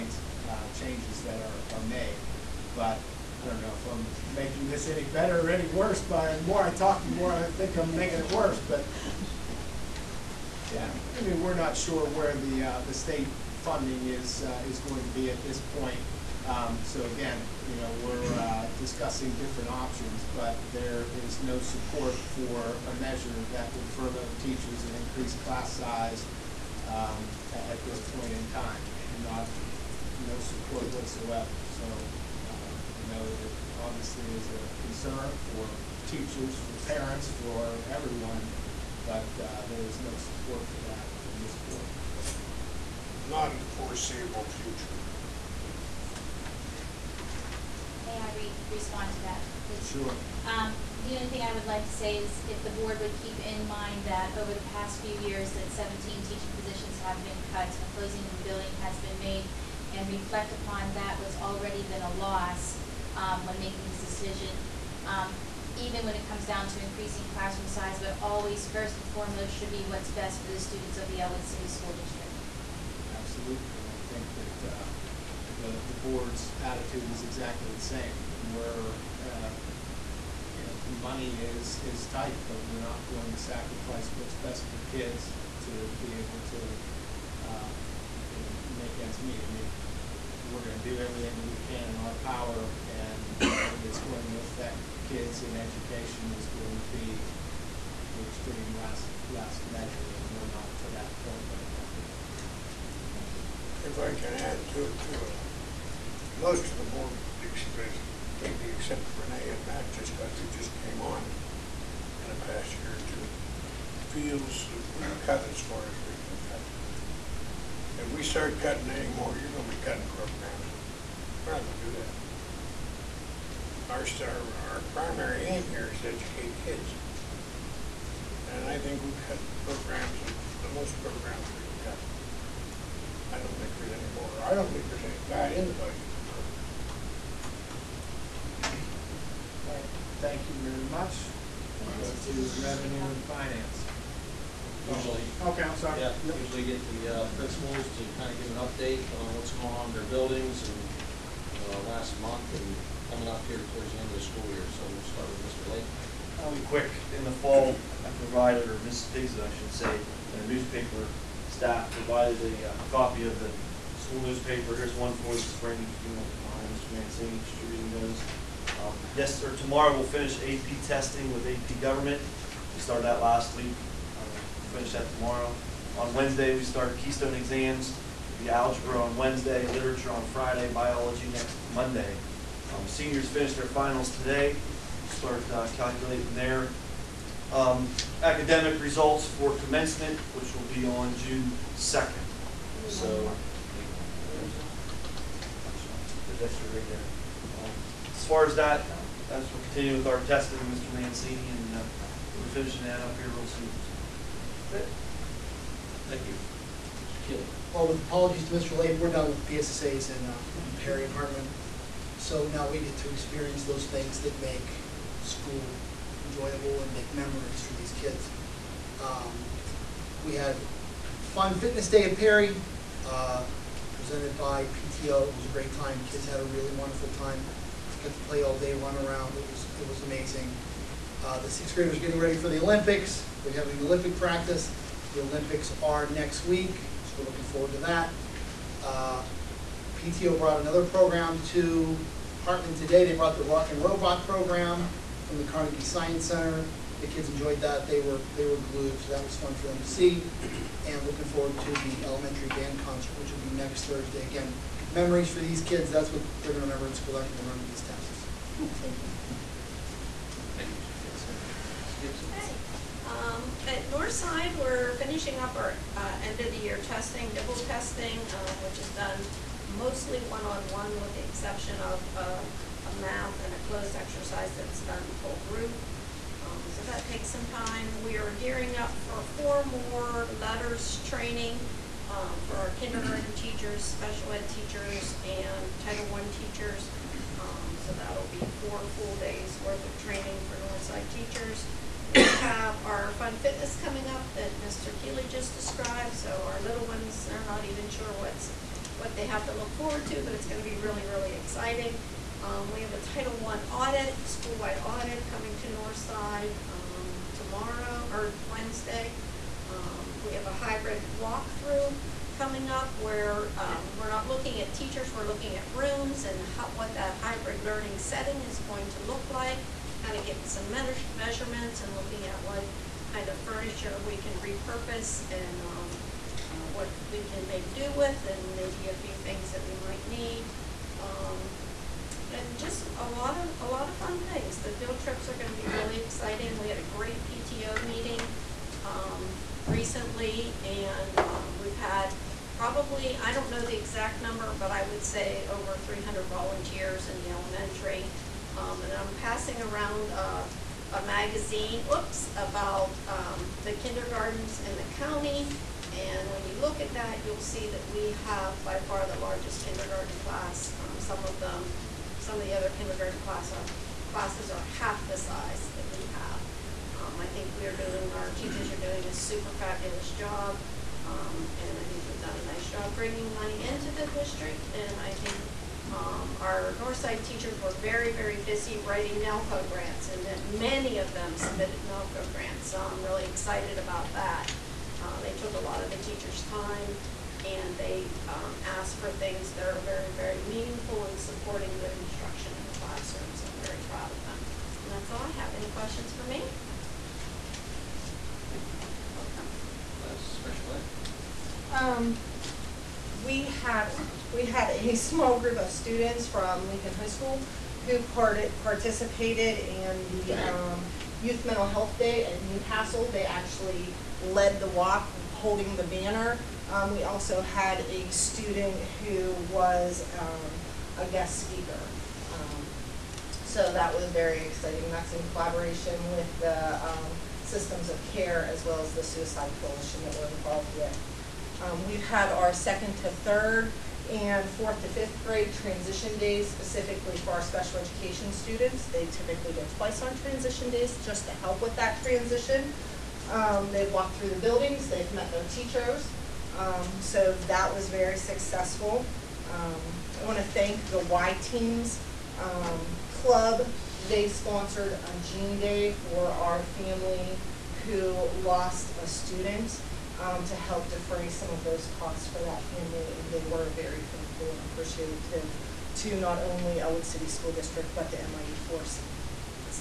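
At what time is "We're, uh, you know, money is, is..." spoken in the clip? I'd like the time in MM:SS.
01:18.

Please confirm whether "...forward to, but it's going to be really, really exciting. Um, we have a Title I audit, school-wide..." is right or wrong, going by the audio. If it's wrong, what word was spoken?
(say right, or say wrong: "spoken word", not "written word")
right.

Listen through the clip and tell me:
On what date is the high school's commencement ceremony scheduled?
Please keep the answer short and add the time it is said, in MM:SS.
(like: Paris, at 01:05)
June 2nd, at 03:11.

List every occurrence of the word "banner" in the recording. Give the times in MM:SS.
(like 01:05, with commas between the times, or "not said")
06:55.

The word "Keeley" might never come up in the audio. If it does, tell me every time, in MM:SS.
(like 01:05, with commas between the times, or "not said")
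03:27, 04:55.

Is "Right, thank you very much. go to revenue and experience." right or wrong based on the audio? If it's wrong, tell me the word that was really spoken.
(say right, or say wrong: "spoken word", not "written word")
wrong: "finance", not "experience".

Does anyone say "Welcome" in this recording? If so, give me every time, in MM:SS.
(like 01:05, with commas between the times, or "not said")
06:39.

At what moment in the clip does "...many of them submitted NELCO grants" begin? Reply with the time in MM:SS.
06:20.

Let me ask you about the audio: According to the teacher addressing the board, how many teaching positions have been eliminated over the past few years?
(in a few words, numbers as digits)
17.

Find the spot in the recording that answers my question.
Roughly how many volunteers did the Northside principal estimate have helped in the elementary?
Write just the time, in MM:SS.
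05:45.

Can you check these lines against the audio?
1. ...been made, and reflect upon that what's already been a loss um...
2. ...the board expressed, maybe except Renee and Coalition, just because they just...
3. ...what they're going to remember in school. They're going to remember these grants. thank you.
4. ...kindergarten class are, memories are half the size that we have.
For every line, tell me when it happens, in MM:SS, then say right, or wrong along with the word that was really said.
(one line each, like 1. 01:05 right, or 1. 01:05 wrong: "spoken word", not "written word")
1. 00:58 right
2. 01:46 wrong: "Matt", not "Coalition"
3. 04:16 wrong: "tests", not "grants"
4. 06:02 wrong: "classes", not "memories".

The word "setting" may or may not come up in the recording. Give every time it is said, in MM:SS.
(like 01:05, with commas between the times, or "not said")
05:17.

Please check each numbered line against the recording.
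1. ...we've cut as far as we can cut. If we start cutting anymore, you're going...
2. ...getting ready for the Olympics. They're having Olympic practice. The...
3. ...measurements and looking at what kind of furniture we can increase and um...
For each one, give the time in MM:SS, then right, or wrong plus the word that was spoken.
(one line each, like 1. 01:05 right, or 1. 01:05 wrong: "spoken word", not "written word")
1. 01:55 right
2. 03:51 right
3. 05:21 wrong: "repurpose", not "increase".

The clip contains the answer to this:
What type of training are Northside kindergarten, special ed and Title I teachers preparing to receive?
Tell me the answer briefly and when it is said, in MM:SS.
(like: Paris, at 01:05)
LETRS training, at 04:40.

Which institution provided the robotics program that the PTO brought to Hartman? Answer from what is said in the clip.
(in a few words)
Carnegie Science Center.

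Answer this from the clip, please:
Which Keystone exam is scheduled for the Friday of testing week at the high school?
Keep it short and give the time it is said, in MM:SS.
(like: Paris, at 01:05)
Literature, at 02:59.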